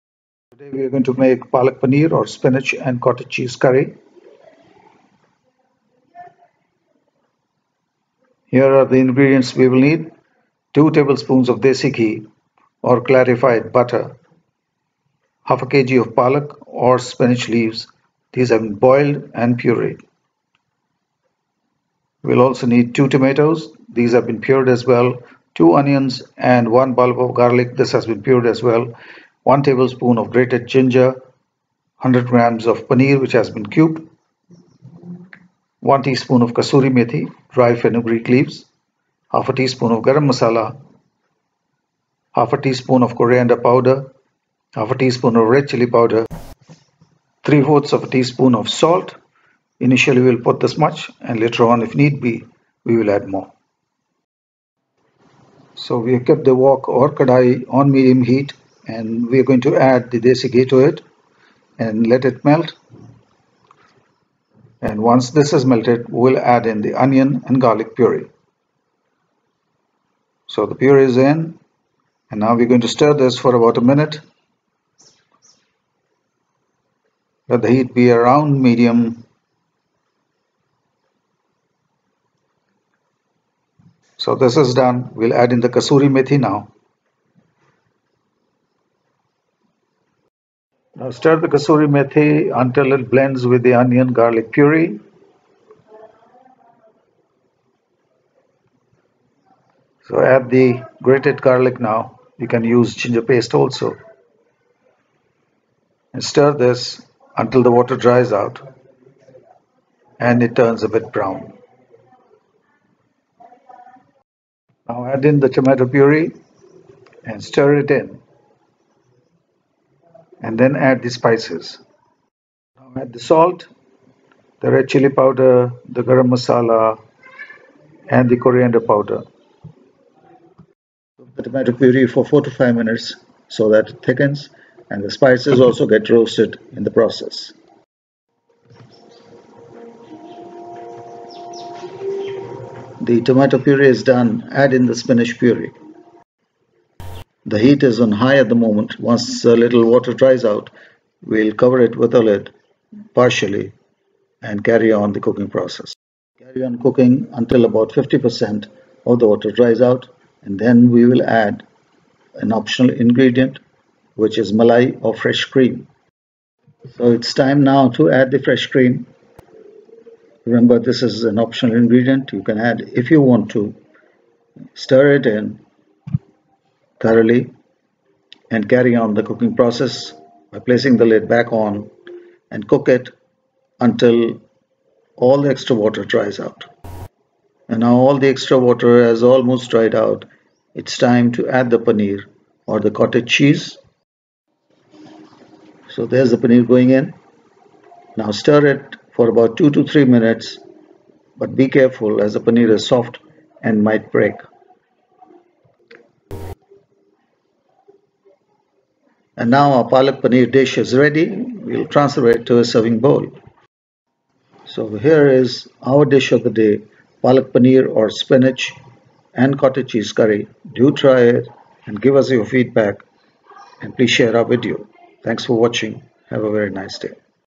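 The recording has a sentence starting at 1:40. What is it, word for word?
So add the grated garlic now.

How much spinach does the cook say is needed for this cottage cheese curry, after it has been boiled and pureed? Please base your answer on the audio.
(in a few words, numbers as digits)
half a kg.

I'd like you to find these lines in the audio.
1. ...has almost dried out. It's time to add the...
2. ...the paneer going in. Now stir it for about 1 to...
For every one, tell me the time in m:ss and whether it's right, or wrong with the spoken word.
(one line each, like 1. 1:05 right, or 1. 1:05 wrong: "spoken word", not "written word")
1. 3:09 right
2. 3:16 wrong: "2", not "1".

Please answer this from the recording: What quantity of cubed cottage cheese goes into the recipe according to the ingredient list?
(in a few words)
100 grams.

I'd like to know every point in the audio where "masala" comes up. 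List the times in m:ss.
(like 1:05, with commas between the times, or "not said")
0:40, 2:06.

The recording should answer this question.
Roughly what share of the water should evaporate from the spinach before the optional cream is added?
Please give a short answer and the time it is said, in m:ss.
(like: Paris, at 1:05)
50 percent, at 2:37.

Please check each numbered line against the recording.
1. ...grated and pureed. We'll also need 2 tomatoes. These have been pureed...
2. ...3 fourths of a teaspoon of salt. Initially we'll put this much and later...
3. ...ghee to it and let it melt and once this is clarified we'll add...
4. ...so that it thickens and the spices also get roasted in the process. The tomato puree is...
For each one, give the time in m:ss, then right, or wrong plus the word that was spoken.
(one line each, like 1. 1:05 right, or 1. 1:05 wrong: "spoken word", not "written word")
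1. 0:18 wrong: "boiled", not "grated"
2. 0:47 right
3. 1:00 wrong: "melted", not "clarified"
4. 2:13 right.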